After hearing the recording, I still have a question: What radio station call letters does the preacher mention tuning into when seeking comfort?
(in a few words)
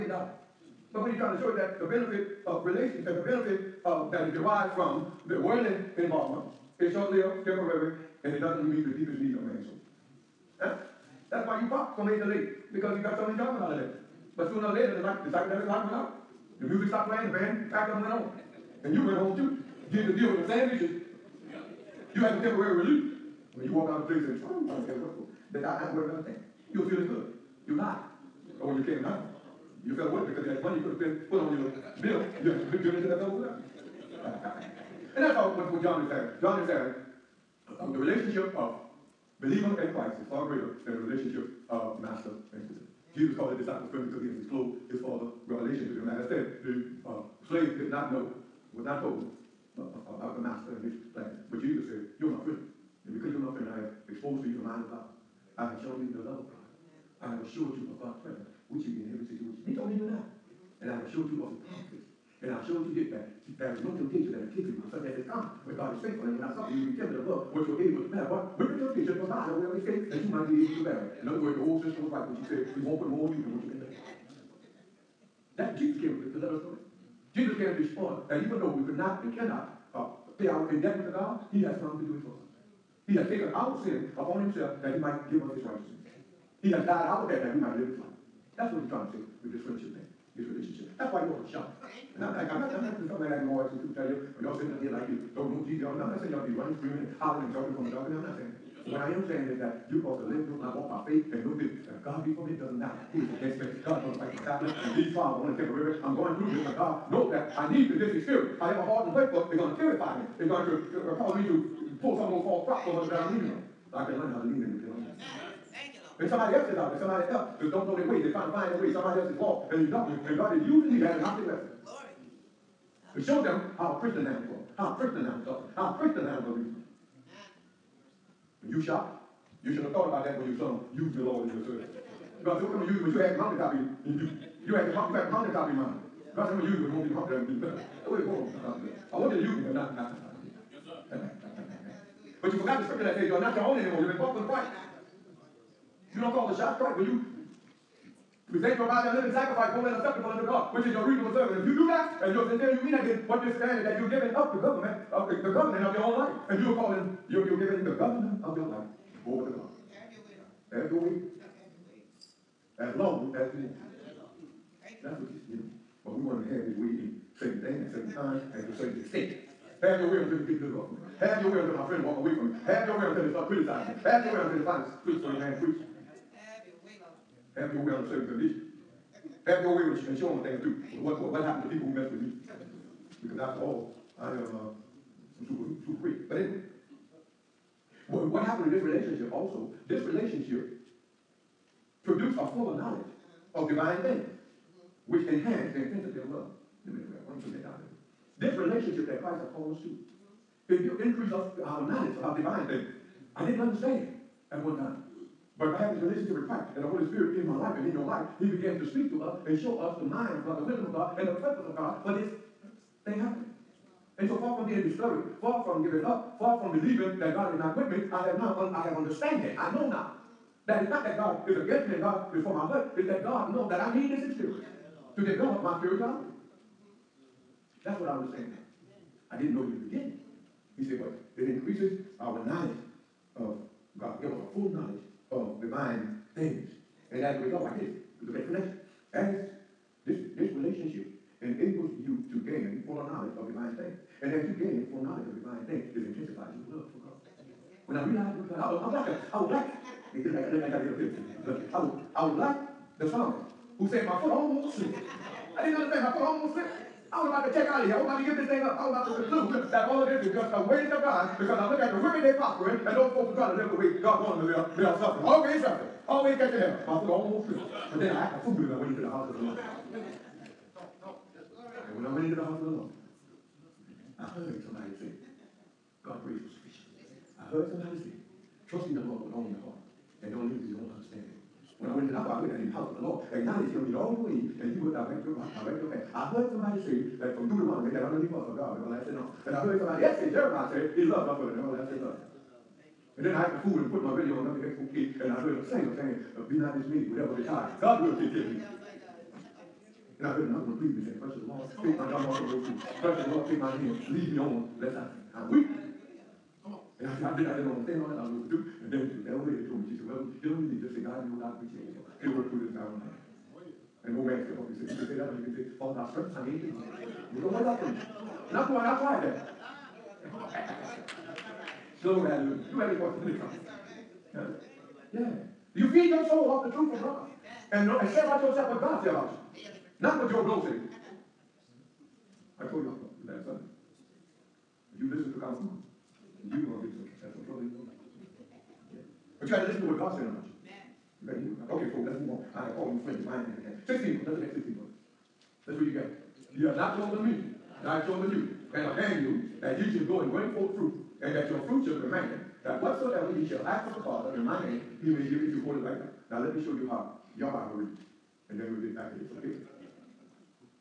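WXOP.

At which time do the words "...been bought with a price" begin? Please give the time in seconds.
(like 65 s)
144 s.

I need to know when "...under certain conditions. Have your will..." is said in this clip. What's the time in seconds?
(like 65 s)
177 s.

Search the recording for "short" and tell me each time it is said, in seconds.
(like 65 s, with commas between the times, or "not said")
6 s.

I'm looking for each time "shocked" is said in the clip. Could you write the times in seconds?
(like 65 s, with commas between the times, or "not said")
91 s, 128 s.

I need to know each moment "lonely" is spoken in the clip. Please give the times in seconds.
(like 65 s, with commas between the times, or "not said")
not said.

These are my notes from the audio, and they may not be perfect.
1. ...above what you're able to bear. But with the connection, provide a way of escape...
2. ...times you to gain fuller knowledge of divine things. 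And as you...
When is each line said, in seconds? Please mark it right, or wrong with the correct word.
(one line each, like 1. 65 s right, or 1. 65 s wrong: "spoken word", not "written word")
1. 67 s wrong: "temptation", not "connection"
2. 241 s wrong: "enables", not "times".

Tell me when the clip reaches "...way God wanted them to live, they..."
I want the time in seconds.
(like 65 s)
263 s.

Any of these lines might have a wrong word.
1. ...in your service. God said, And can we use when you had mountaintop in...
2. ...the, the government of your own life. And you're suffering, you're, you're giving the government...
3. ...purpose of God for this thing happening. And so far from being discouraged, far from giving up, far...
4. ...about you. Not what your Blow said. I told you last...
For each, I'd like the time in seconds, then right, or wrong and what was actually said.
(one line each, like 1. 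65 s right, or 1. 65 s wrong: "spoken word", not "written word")
1. 131 s wrong: "What", not "And"
2. 155 s wrong: "calling", not "suffering"
3. 211 s right
4. 329 s right.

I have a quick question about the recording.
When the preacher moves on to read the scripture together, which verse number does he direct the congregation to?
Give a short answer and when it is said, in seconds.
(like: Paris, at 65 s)
16, at 344 s.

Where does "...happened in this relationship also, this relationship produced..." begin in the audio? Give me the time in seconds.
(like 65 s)
188 s.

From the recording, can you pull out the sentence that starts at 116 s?
Somebody else who don't know their way, they're trying to find their way, somebody else is lost and you don't.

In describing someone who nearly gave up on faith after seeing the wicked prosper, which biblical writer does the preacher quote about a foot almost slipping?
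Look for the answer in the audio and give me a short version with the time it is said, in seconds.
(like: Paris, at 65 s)
The psalmist, at 252 s.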